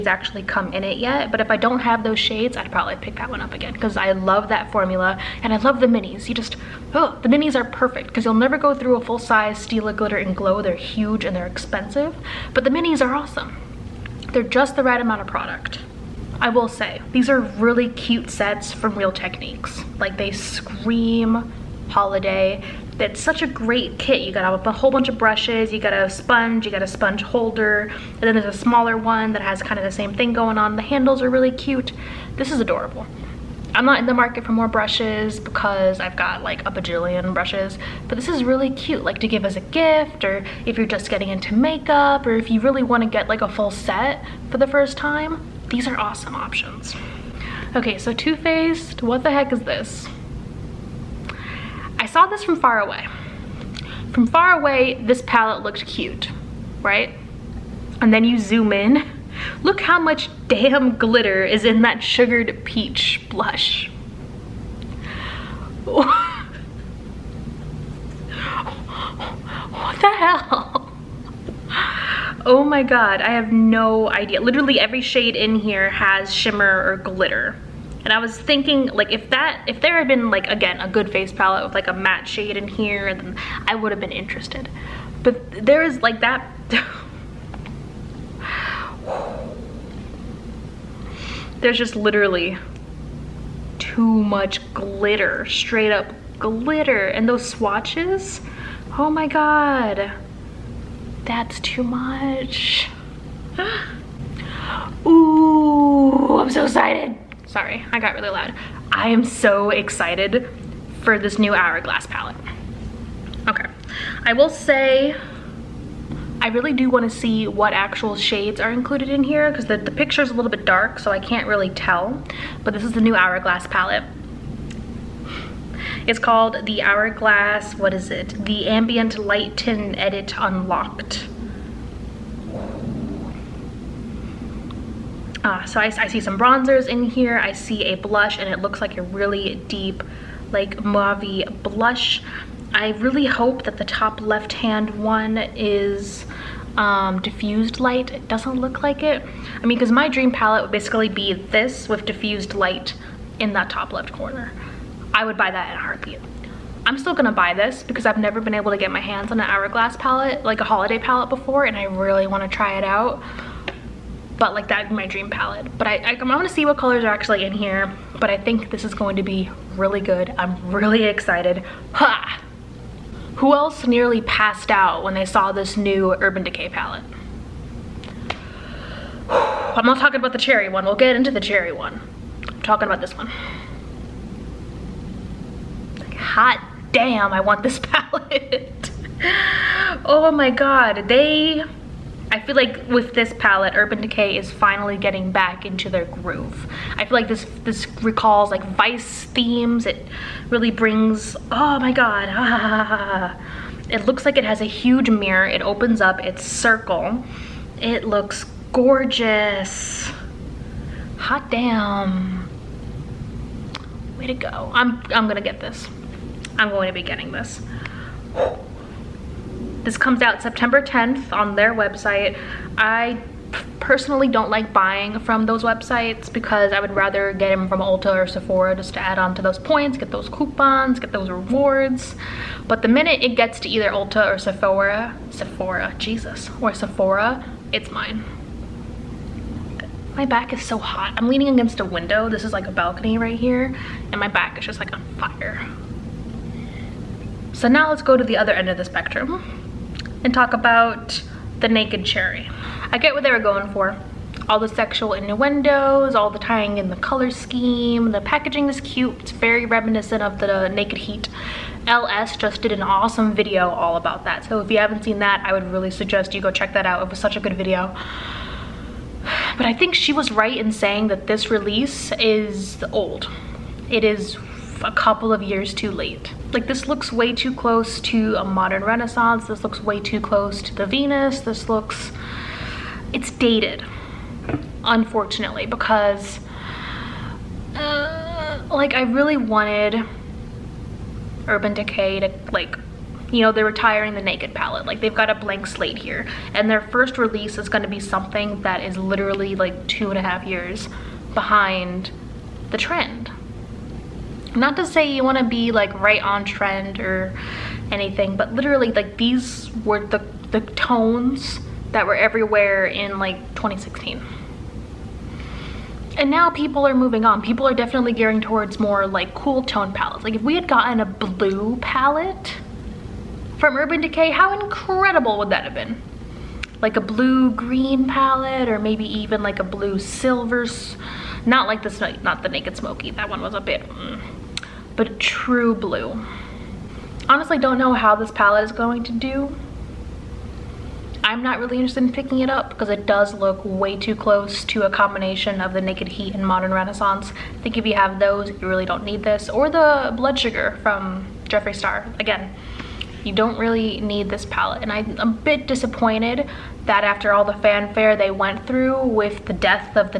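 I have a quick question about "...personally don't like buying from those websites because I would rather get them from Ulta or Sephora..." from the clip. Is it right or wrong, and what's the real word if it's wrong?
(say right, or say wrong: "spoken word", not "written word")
right.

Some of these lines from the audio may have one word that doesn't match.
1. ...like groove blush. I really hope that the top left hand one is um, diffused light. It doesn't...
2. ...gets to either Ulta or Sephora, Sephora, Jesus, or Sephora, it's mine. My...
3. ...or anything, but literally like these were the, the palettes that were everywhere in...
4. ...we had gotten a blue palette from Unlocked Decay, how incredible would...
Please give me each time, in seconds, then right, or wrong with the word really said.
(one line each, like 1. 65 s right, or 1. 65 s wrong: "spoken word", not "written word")
1. 140 s wrong: "mauve", not "groove"
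2. 233 s right
3. 306 s wrong: "tones", not "palettes"
4. 320 s wrong: "Urban", not "Unlocked".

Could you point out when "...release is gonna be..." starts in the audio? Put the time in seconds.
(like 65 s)
297 s.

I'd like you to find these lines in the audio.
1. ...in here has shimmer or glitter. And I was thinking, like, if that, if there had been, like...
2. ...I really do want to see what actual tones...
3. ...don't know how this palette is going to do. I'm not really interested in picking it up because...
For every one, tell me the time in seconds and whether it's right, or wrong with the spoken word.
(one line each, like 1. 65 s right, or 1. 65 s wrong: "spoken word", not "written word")
1. 75 s right
2. 116 s wrong: "shades", not "tones"
3. 337 s right.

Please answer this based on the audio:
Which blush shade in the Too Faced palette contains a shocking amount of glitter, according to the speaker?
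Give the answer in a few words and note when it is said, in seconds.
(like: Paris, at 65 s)
Sugared Peach, at 62 s.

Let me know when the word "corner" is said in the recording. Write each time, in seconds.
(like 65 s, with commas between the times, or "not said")
154 s.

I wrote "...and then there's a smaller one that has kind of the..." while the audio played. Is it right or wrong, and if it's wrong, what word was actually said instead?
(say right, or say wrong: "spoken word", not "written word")
right.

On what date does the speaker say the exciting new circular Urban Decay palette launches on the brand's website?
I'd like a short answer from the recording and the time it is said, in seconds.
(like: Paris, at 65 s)
September 10th, at 220 s.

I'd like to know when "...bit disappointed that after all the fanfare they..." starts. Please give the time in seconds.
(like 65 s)
355 s.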